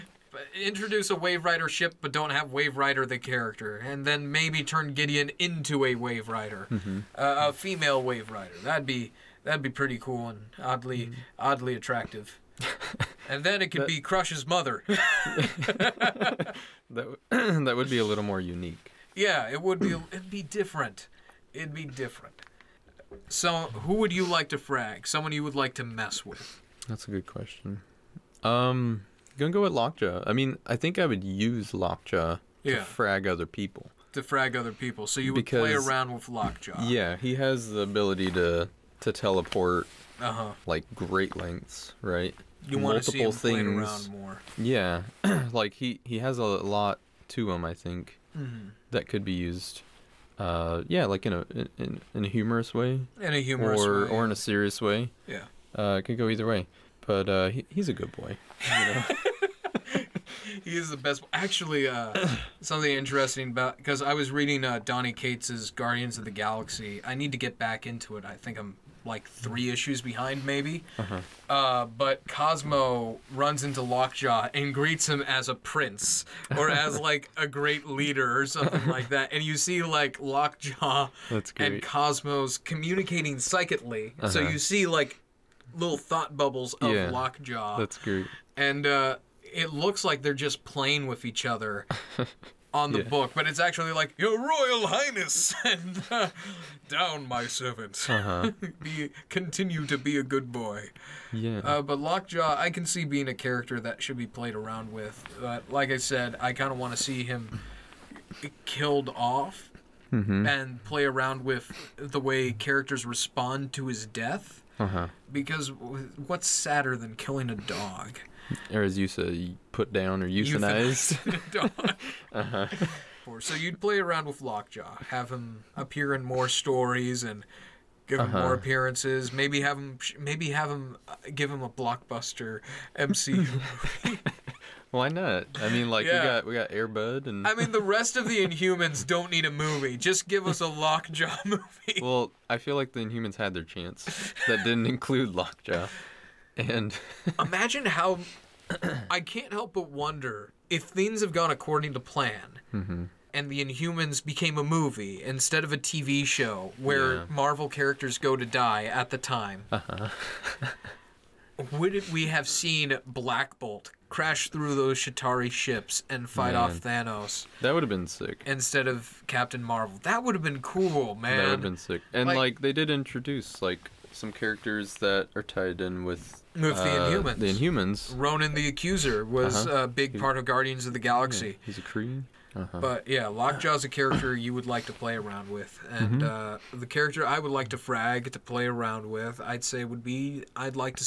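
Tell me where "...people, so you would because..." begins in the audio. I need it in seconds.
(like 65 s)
34 s.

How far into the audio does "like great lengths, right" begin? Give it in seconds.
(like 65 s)
40 s.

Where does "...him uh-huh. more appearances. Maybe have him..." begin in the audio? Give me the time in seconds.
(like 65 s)
128 s.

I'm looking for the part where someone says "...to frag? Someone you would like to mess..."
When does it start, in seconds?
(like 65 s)
24 s.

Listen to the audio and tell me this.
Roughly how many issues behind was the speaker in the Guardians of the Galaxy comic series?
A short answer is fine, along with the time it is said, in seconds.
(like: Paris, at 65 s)
3, at 69 s.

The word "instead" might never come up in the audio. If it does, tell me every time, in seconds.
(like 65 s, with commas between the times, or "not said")
155 s, 168 s.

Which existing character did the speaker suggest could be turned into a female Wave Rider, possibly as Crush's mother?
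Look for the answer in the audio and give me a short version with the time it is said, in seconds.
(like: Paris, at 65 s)
Gideon, at 4 s.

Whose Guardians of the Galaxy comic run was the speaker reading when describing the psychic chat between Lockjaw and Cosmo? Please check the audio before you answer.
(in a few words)
Donny Cates.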